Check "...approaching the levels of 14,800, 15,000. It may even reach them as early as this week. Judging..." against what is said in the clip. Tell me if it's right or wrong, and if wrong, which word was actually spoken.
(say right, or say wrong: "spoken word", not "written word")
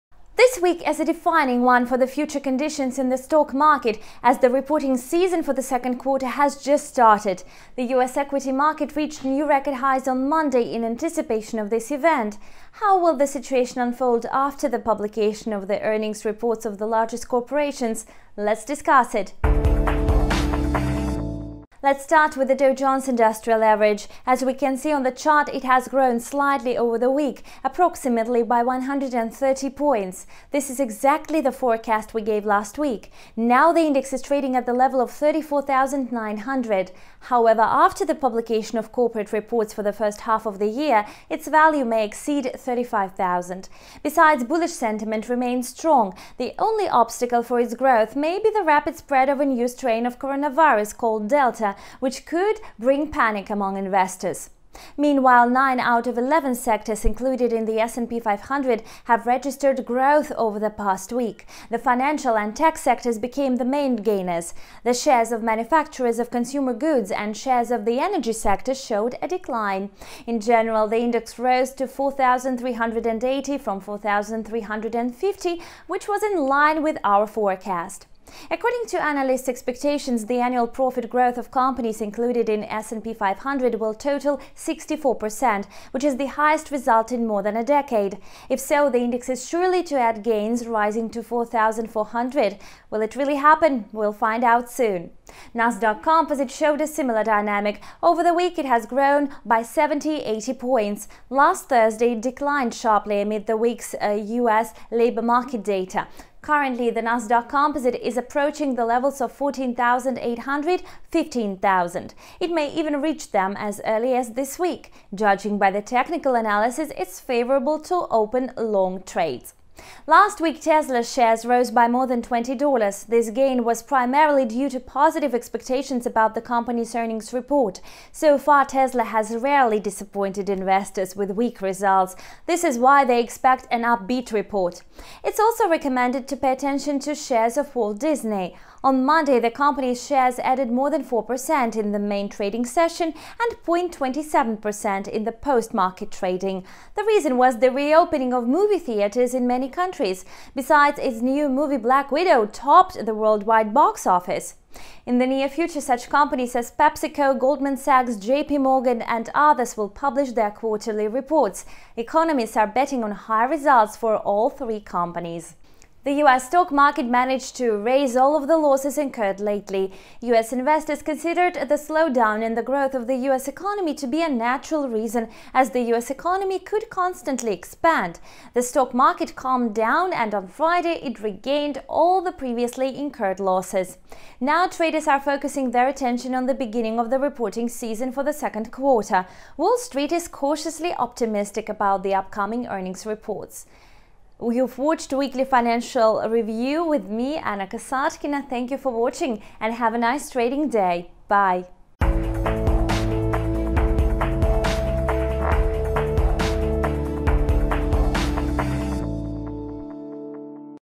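right.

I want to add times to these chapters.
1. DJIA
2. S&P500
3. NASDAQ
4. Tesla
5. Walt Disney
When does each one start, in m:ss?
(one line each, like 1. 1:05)
1. 0:21
2. 0:55
3. 1:35
4. 1:59
5. 2:14.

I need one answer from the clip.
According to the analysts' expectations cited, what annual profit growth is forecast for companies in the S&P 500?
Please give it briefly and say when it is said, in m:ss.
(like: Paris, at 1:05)
64%, at 1:24.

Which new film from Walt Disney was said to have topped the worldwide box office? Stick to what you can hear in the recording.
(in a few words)
Black Widow.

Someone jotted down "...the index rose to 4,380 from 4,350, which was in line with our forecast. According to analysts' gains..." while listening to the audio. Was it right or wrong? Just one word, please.
wrong.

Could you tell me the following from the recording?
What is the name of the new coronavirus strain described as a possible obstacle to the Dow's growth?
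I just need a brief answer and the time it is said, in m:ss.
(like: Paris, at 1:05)
Delta, at 0:51.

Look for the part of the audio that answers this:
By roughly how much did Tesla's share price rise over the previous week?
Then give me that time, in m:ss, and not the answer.
2:01.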